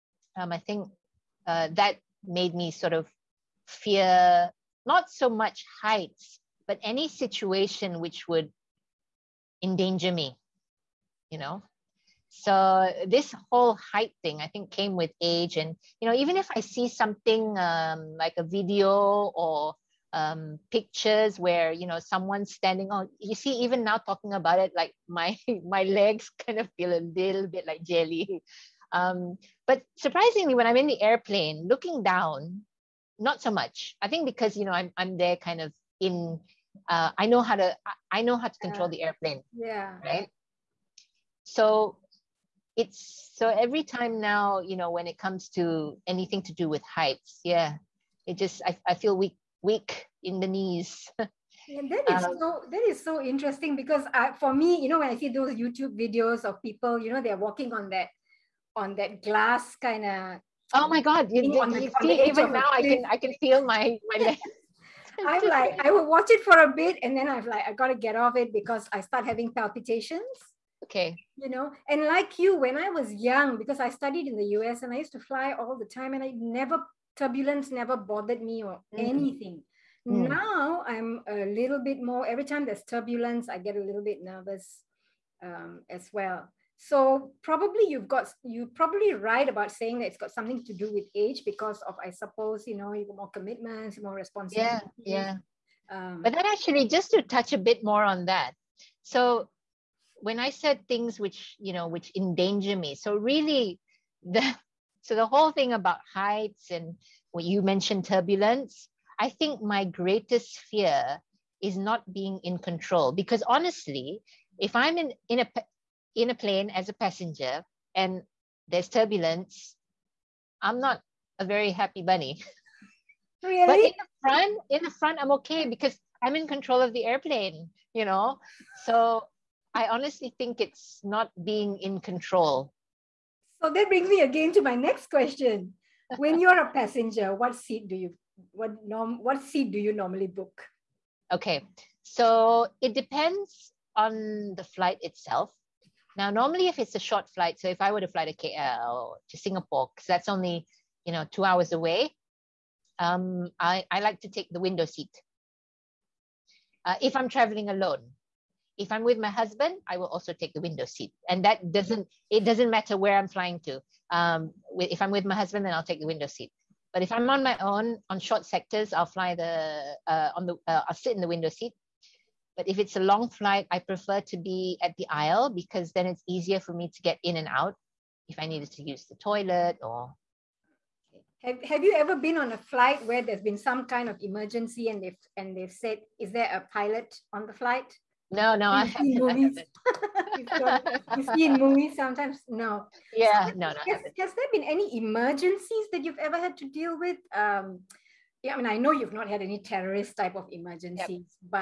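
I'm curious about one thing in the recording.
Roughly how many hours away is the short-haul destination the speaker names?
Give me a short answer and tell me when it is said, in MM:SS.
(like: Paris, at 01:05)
2, at 02:31.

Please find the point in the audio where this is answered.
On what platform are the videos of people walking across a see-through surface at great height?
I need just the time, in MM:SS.
00:55.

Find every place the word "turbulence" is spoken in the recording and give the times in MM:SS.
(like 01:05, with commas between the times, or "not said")
01:17, 01:22, 01:48, 01:58.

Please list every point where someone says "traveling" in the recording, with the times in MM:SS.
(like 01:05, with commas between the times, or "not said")
02:37.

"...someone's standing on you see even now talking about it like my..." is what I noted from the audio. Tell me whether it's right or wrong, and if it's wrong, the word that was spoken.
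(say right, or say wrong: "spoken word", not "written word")
right.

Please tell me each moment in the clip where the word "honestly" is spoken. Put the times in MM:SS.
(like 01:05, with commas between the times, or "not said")
01:53, 02:09.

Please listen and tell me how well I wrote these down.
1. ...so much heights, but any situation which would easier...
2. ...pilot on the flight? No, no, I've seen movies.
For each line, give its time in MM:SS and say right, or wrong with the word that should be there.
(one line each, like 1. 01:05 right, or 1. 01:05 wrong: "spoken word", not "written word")
1. 00:05 wrong: "endanger", not "easier"
2. 03:06 right.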